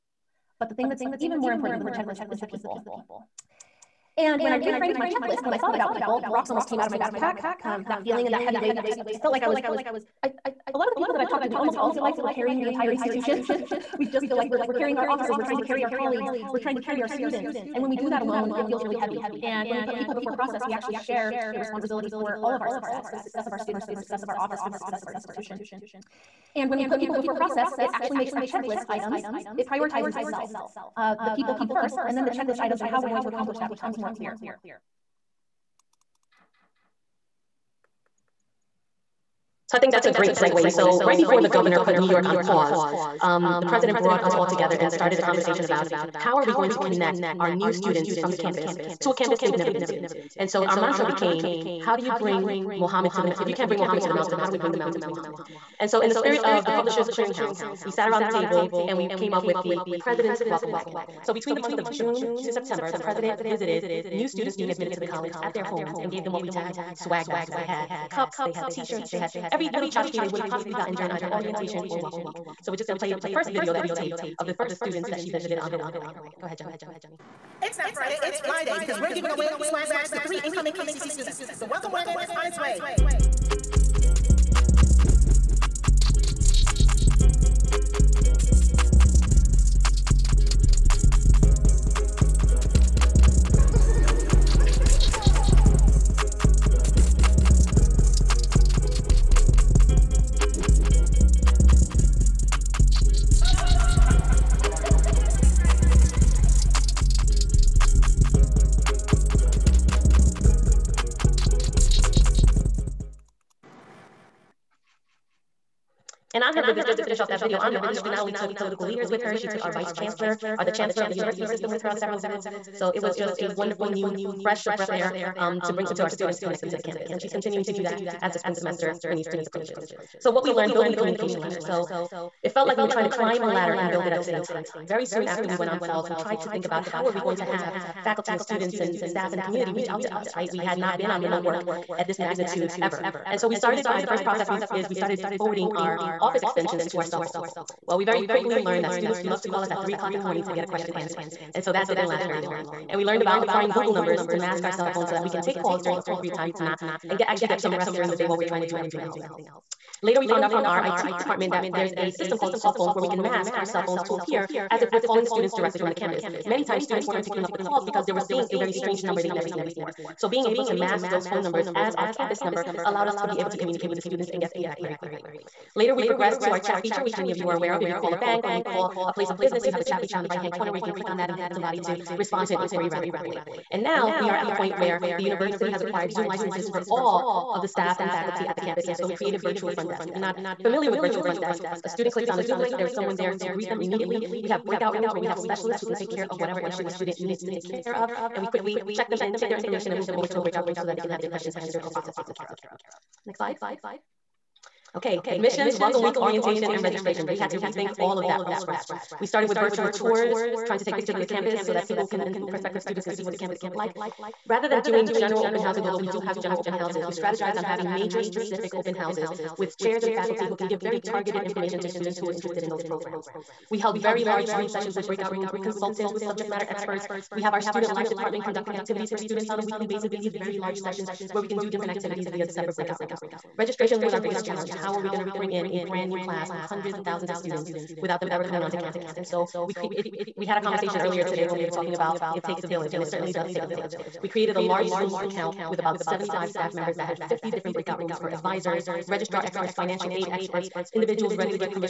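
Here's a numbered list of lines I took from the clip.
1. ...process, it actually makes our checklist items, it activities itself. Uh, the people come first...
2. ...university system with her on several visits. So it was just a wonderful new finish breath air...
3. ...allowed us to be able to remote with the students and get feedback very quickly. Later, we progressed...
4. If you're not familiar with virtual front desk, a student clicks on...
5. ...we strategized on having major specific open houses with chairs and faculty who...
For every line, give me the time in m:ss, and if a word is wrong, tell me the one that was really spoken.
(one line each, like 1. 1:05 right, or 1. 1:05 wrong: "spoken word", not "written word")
1. 0:27 wrong: "prioritizes", not "activities"
2. 2:01 wrong: "fresh", not "finish"
3. 2:52 wrong: "communicate", not "remote"
4. 3:10 right
5. 3:37 right.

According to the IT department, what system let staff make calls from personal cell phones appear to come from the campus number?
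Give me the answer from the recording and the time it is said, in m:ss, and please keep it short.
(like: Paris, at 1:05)
soft phones, at 2:42.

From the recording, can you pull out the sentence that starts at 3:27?
We had to rethink all of that from scratch.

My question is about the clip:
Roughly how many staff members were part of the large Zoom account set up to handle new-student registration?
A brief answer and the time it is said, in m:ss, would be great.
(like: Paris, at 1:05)
75, at 4:05.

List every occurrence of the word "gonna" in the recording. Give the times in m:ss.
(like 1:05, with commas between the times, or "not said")
1:12, 3:55.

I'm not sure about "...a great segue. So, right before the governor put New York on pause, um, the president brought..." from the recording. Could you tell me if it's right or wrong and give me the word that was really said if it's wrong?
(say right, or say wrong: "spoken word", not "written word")
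right.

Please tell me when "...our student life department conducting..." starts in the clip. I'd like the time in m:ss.
3:47.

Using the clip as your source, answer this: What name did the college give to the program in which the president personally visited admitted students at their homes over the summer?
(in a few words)
President's Welcome Wagon.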